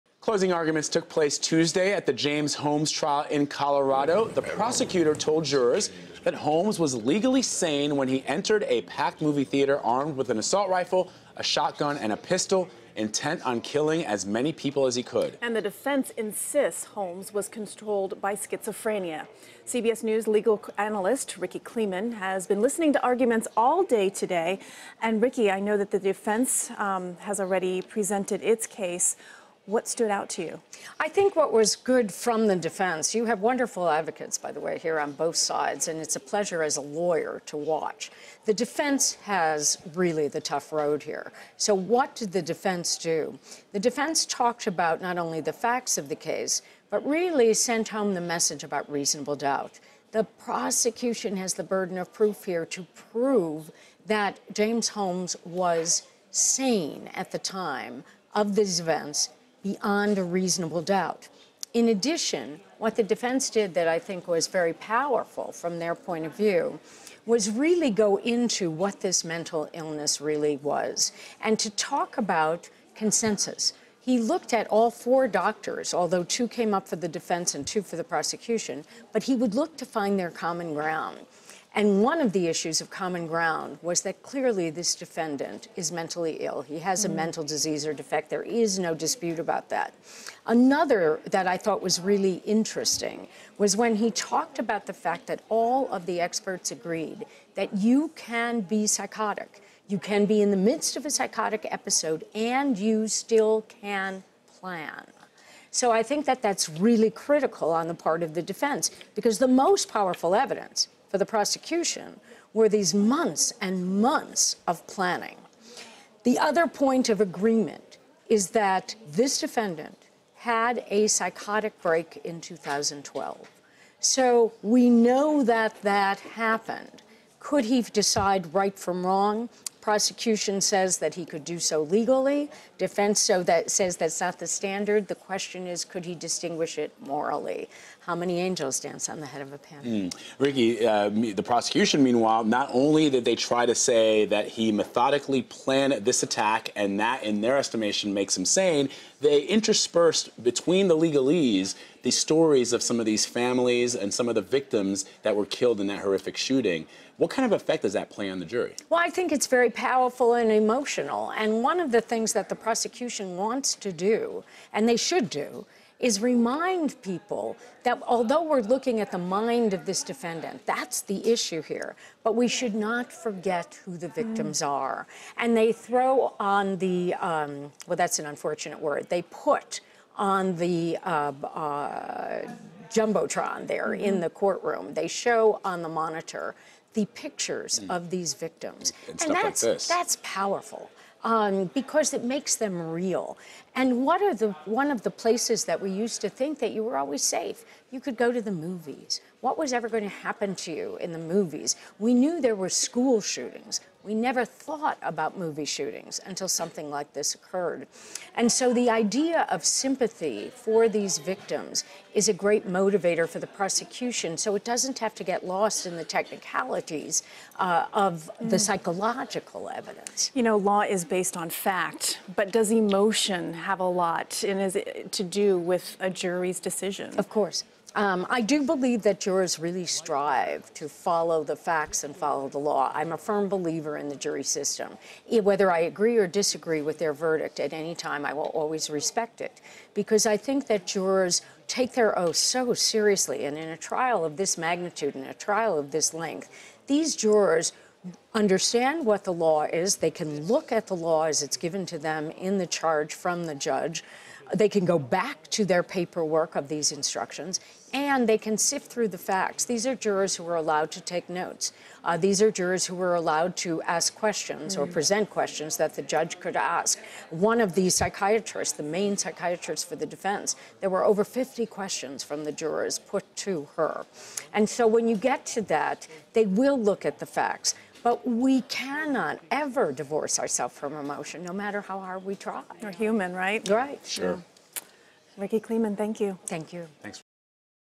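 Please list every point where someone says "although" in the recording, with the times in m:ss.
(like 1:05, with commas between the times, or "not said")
1:15, 2:48.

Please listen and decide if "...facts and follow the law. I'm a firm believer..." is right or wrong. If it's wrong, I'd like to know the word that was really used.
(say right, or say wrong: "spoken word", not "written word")
right.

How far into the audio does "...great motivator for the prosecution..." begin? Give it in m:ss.
3:32.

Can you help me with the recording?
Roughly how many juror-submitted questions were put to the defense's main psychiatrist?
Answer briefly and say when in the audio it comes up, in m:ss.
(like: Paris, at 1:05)
over 50, at 4:31.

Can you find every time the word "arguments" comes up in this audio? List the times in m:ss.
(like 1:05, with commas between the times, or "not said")
0:00, 0:23.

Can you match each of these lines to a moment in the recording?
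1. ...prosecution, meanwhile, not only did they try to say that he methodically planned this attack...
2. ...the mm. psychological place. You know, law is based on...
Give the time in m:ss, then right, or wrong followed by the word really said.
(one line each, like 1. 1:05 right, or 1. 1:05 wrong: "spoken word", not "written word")
1. 2:21 right
2. 3:38 wrong: "evidence", not "place".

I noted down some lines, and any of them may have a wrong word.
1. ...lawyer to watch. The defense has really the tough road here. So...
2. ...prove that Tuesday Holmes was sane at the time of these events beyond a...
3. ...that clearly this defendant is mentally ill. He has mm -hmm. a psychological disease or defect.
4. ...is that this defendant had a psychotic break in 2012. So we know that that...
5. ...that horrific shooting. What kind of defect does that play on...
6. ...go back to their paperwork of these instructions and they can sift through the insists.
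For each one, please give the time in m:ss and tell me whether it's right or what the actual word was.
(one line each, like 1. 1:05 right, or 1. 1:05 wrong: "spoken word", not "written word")
1. 0:36 right
2. 0:53 wrong: "James", not "Tuesday"
3. 1:24 wrong: "mental", not "psychological"
4. 1:58 right
5. 2:35 wrong: "effect", not "defect"
6. 4:14 wrong: "facts", not "insists".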